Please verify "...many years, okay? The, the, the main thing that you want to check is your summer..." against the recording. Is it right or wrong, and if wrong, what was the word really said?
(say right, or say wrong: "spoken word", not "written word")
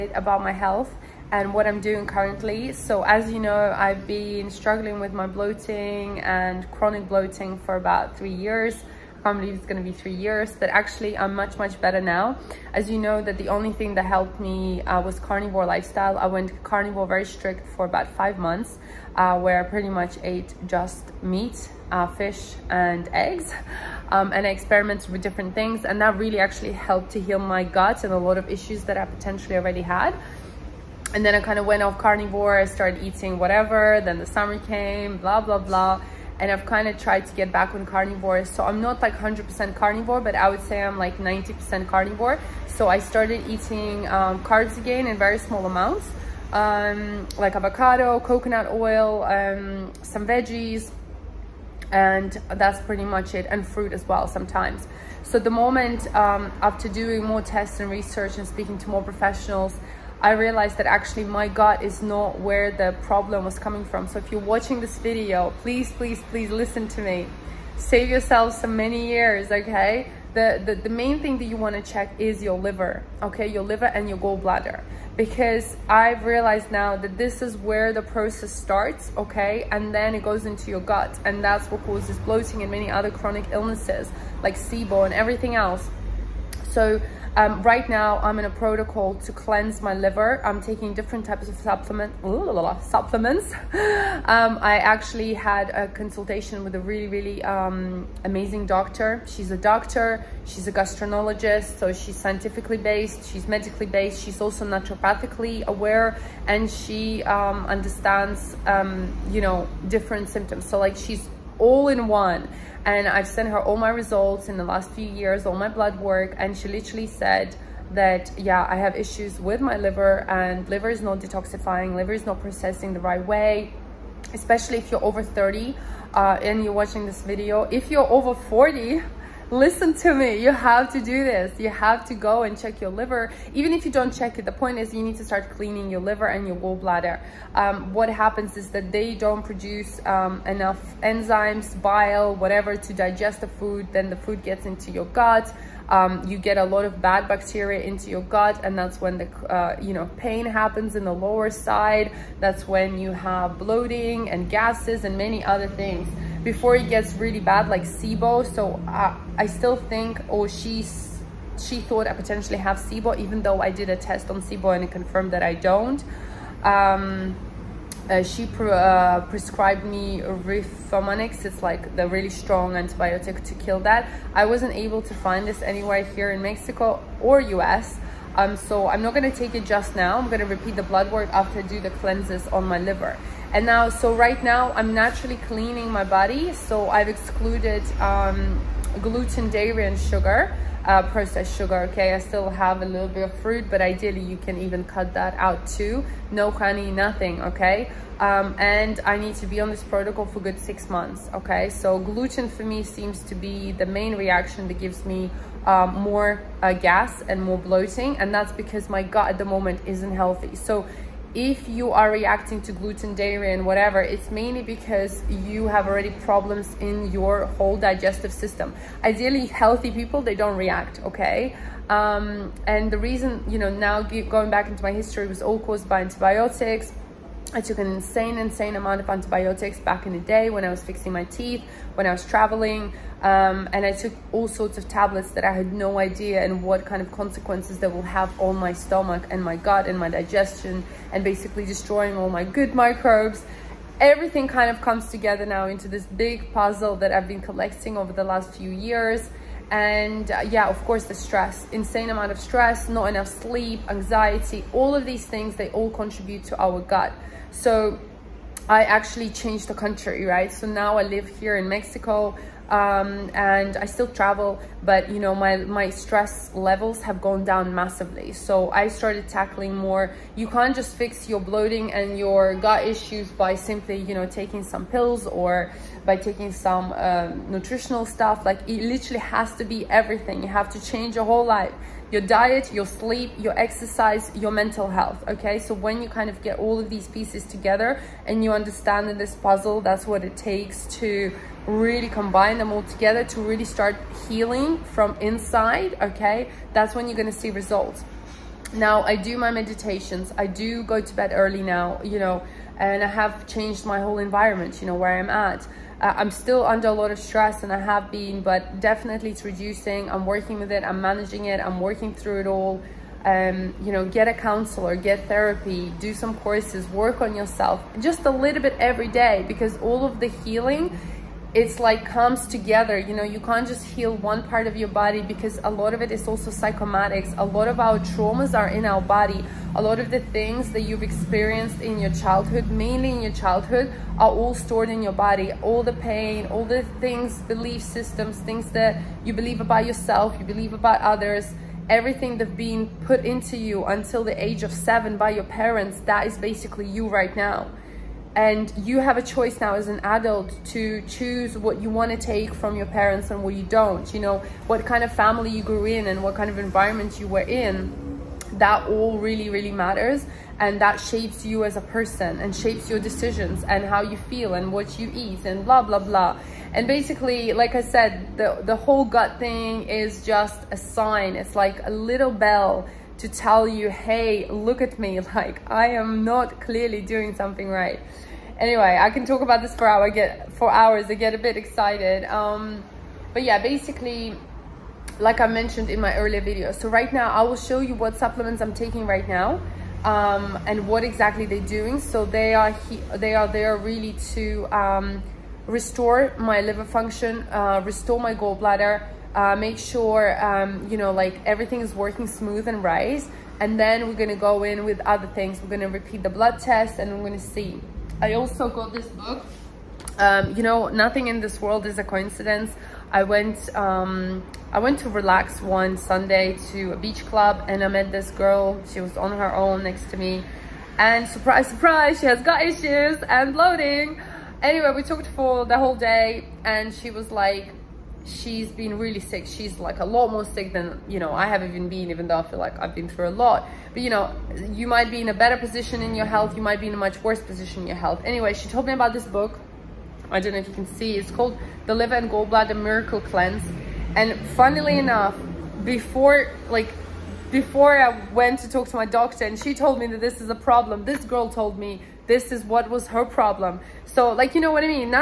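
wrong: "liver", not "summer".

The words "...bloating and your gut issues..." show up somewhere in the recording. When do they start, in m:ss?
4:31.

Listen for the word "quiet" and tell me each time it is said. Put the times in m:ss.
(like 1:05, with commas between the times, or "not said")
not said.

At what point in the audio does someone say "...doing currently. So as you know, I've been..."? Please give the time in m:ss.
0:01.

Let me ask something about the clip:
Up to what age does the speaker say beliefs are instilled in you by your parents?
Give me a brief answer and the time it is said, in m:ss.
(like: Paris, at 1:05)
7, at 5:44.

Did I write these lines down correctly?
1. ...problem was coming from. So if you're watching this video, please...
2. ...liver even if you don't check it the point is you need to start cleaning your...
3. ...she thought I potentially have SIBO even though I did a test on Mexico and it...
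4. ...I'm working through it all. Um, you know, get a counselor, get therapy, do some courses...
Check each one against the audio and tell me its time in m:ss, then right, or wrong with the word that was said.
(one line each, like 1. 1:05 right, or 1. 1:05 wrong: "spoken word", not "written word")
1. 1:03 right
2. 2:12 right
3. 2:41 wrong: "SIBO", not "Mexico"
4. 5:11 right.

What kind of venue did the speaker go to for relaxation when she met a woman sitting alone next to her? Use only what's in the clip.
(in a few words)
Beach club.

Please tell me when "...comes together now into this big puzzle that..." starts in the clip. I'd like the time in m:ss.
4:04.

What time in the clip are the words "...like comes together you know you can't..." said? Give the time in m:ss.
5:21.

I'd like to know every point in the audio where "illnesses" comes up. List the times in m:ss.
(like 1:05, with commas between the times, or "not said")
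1:23.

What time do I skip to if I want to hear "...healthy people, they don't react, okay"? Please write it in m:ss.
3:39.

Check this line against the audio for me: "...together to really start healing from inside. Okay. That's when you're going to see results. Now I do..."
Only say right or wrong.
right.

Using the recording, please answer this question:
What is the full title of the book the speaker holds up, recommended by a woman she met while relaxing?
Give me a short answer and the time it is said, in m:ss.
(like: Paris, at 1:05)
The Liver and Gallbladder Miracle Cleanse, at 7:21.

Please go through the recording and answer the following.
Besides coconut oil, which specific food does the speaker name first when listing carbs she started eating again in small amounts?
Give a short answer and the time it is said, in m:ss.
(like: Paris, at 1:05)
Avocado, at 0:47.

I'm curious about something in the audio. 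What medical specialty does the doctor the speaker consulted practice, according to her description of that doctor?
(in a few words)
Gastroenterologist.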